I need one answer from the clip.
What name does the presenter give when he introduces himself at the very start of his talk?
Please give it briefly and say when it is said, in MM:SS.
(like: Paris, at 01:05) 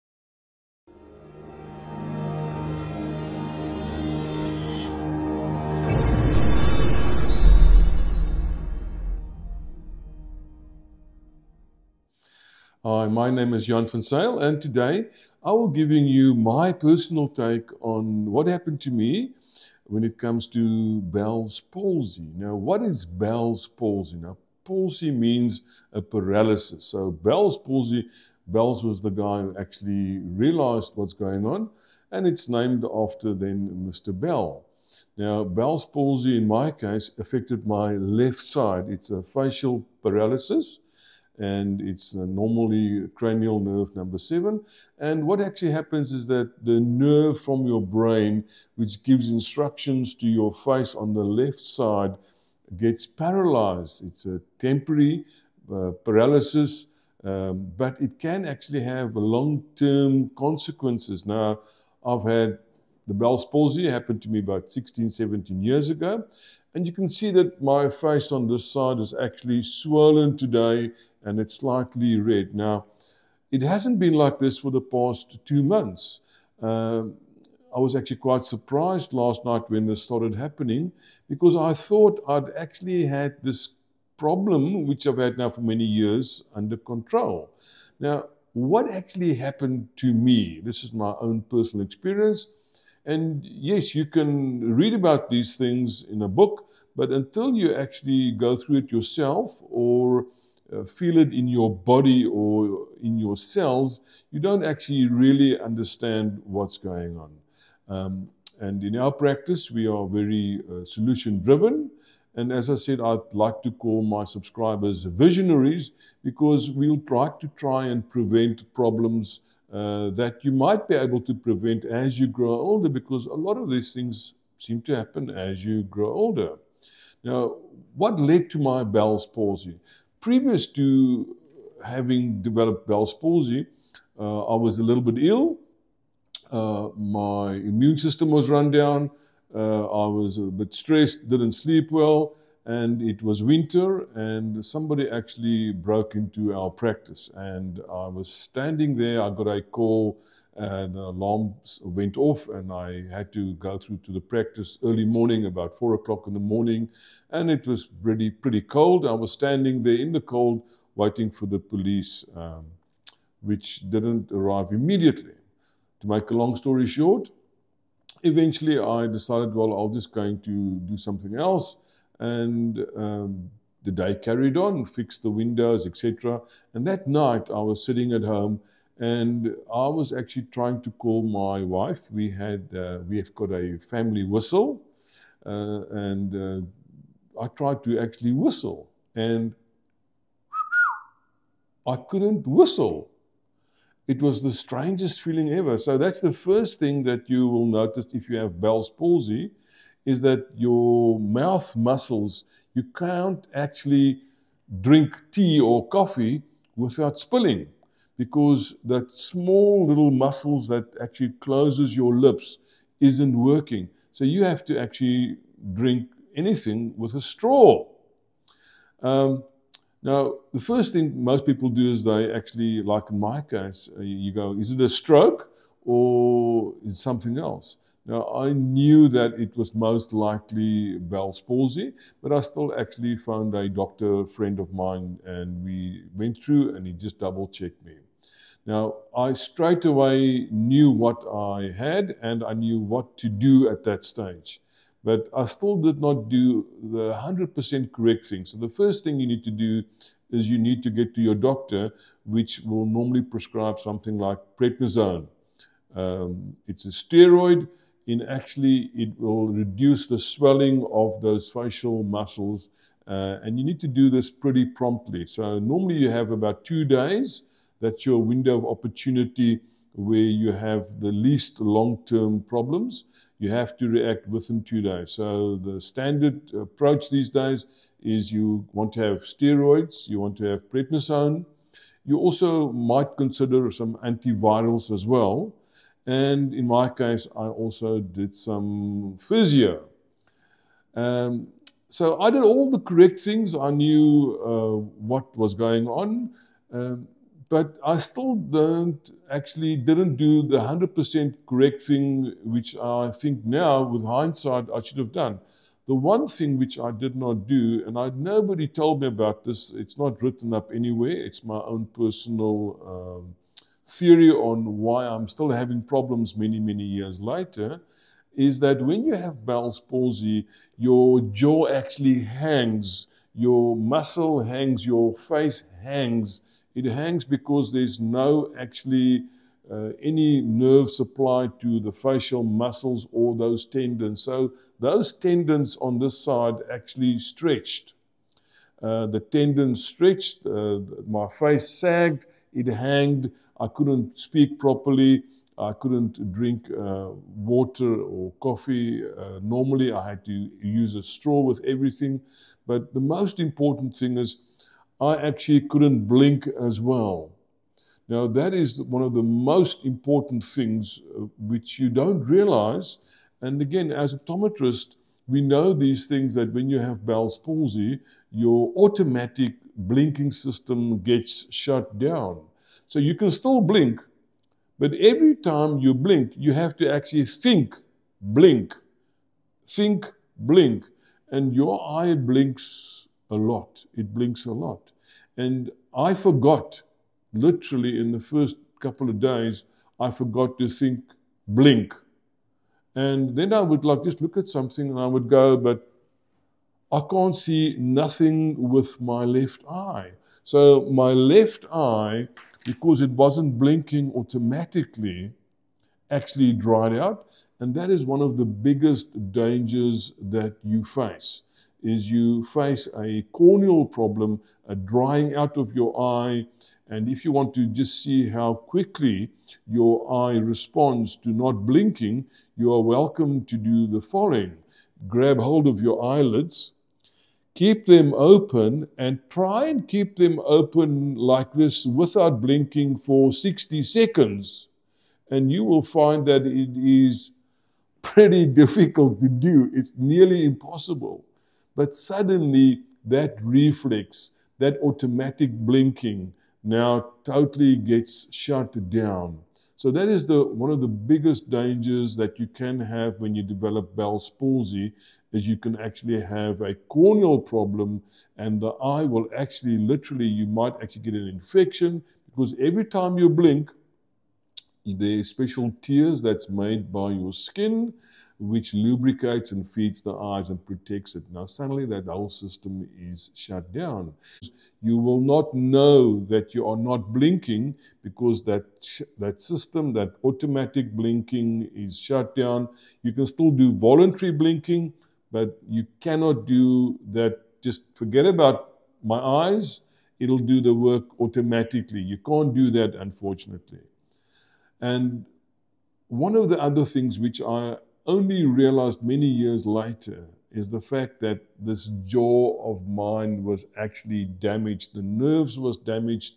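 Jan van Zyl, at 00:13.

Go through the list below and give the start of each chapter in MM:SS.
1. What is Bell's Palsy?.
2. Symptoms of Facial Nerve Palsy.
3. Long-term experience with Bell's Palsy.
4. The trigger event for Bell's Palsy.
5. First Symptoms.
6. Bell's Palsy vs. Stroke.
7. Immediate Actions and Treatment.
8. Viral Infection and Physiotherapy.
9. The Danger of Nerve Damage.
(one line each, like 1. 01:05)
1. 00:22
2. 00:42
3. 01:20
4. 02:06
5. 03:08
6. 03:39
7. 04:04
8. 04:33
9. 05:34.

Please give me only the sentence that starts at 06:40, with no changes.
So my left eye, because it wasn't blinking automatically, actually dried out.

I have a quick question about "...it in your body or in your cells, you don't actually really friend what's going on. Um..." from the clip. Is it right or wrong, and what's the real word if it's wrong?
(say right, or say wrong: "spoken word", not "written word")
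wrong: "understand", not "friend".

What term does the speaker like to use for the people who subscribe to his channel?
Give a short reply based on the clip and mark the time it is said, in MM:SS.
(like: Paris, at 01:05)
visionaries, at 01:55.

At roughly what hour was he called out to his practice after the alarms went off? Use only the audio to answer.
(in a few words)
4 o'clock in the morning.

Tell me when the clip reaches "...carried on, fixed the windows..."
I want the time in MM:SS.
02:54.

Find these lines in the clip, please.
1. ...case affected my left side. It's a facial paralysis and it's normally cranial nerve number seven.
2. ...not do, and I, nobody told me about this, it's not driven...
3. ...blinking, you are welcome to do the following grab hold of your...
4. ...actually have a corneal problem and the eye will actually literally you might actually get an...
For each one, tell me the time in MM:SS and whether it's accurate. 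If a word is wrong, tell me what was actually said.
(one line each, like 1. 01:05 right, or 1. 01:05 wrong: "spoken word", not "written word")
1. 00:36 right
2. 05:07 wrong: "written", not "driven"
3. 07:01 right
4. 07:35 right.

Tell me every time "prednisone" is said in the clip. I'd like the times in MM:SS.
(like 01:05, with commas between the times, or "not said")
04:14, 04:40.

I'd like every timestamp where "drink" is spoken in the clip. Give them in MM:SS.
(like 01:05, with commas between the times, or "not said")
03:24, 03:35, 05:46.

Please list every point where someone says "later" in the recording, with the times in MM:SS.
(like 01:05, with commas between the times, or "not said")
05:17, 08:19.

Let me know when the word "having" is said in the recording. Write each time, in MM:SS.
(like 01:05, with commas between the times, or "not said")
02:11, 05:15.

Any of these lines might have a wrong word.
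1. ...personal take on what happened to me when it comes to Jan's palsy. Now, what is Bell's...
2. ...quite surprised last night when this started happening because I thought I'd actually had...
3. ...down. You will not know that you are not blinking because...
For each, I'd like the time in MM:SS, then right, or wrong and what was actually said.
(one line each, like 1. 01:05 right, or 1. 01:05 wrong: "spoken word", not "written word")
1. 00:16 wrong: "Bell", not "Jan"
2. 01:18 right
3. 07:53 right.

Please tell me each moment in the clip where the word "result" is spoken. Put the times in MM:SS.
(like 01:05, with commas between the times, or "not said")
not said.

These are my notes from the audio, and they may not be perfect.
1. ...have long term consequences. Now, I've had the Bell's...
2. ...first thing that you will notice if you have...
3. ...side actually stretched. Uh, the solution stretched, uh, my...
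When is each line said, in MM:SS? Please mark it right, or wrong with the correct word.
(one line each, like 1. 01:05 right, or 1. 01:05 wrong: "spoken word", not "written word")
1. 00:58 right
2. 03:16 right
3. 05:36 wrong: "tendon", not "solution".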